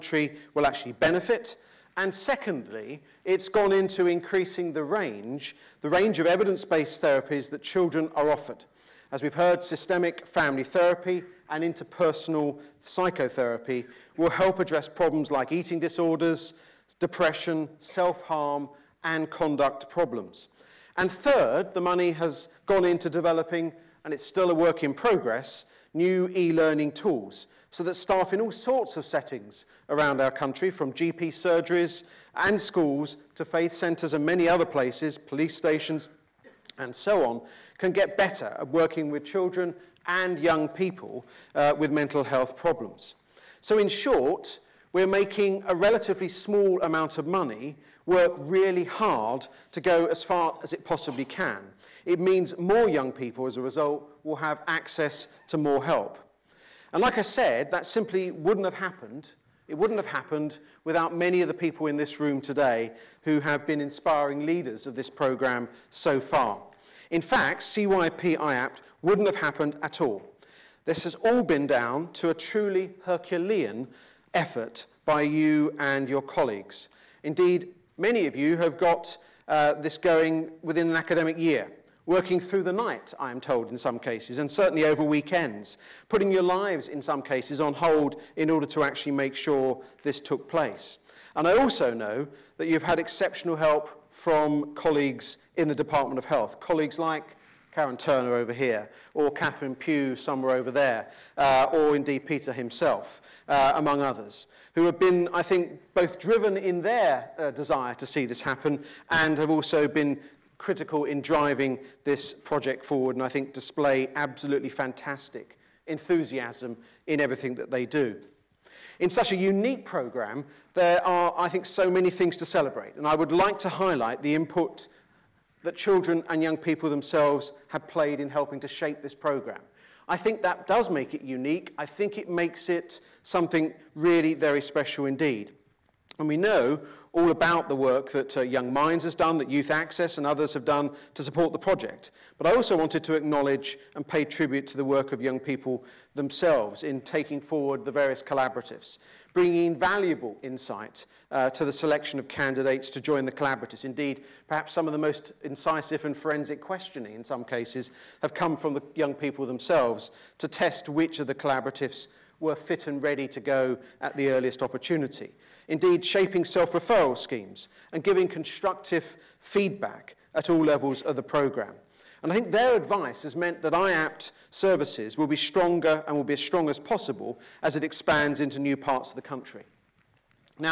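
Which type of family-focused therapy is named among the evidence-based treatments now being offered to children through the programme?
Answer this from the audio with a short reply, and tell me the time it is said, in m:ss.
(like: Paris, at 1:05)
Systemic family therapy, at 0:09.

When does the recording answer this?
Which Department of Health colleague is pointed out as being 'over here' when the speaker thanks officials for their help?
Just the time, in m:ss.
1:37.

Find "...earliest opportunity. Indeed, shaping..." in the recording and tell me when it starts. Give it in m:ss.
2:44.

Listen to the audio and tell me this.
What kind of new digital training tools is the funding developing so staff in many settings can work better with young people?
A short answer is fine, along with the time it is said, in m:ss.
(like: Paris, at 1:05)
E-learning tools, at 0:26.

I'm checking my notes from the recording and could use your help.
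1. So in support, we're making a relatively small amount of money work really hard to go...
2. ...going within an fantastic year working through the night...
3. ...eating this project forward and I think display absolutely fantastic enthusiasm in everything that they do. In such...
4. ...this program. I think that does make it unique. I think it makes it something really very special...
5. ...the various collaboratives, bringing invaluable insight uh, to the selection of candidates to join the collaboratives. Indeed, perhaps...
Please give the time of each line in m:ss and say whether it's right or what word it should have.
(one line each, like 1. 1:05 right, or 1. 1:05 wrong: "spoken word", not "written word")
1. 0:43 wrong: "short", not "support"
2. 1:19 wrong: "academic", not "fantastic"
3. 1:51 wrong: "driving", not "eating"
4. 2:09 right
5. 2:27 right.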